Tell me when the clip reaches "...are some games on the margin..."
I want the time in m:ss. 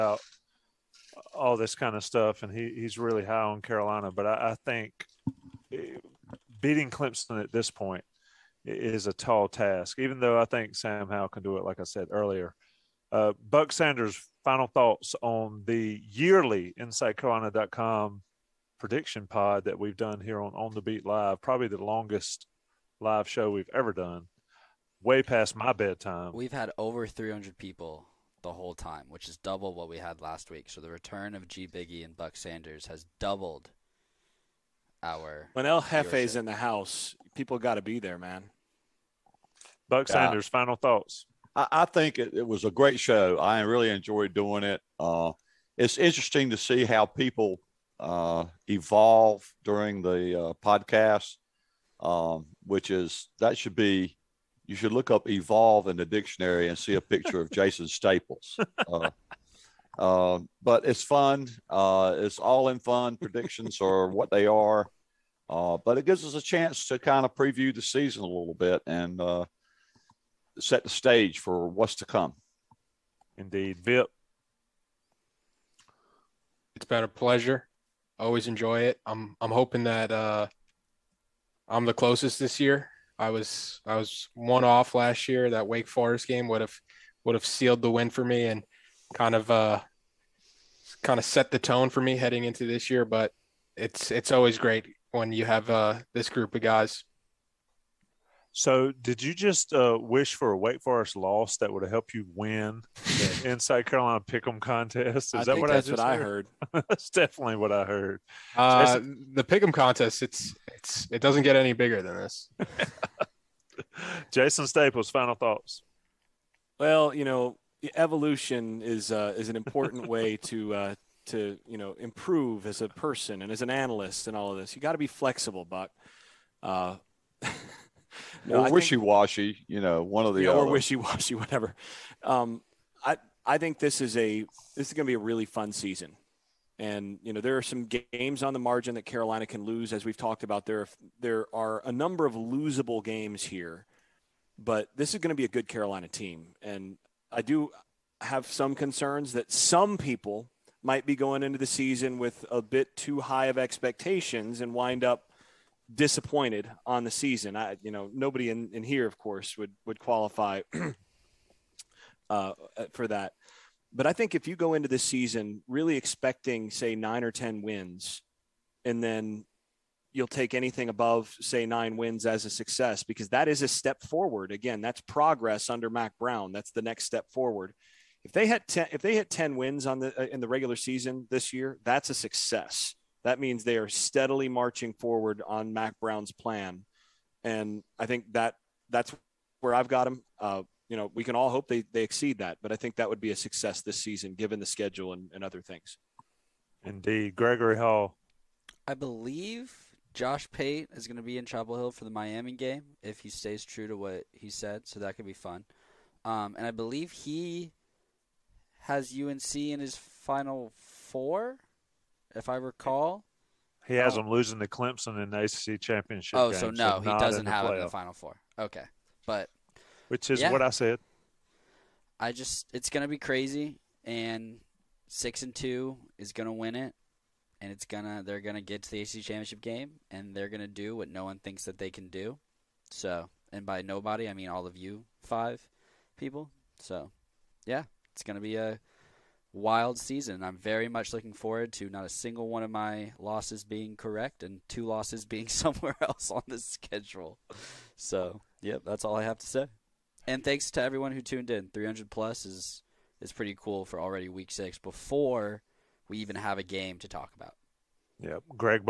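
2:17.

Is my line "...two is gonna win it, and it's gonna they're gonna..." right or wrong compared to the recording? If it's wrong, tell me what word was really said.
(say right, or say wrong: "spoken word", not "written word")
right.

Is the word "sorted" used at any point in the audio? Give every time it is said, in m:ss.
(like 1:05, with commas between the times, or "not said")
not said.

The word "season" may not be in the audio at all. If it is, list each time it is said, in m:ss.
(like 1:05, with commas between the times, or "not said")
1:07, 2:15, 2:31, 2:37, 2:45, 3:00, 3:13, 3:59.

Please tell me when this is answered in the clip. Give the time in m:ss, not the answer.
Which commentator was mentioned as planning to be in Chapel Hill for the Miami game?
3:20.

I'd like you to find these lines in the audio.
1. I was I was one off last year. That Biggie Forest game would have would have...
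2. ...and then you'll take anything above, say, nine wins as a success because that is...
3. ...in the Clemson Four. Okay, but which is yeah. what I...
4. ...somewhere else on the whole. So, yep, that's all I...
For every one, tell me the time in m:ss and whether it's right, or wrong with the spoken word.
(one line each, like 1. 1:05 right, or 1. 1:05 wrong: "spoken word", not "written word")
1. 1:23 wrong: "Wake", not "Biggie"
2. 2:48 right
3. 3:37 wrong: "Final", not "Clemson"
4. 4:05 wrong: "schedule", not "whole".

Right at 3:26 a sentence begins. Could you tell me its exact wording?
Um, and I believe he has UNC in his final four if I recall.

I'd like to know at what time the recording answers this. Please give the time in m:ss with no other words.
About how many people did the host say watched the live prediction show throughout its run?
0:26.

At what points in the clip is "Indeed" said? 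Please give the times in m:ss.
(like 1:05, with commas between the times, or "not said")
1:13, 3:16.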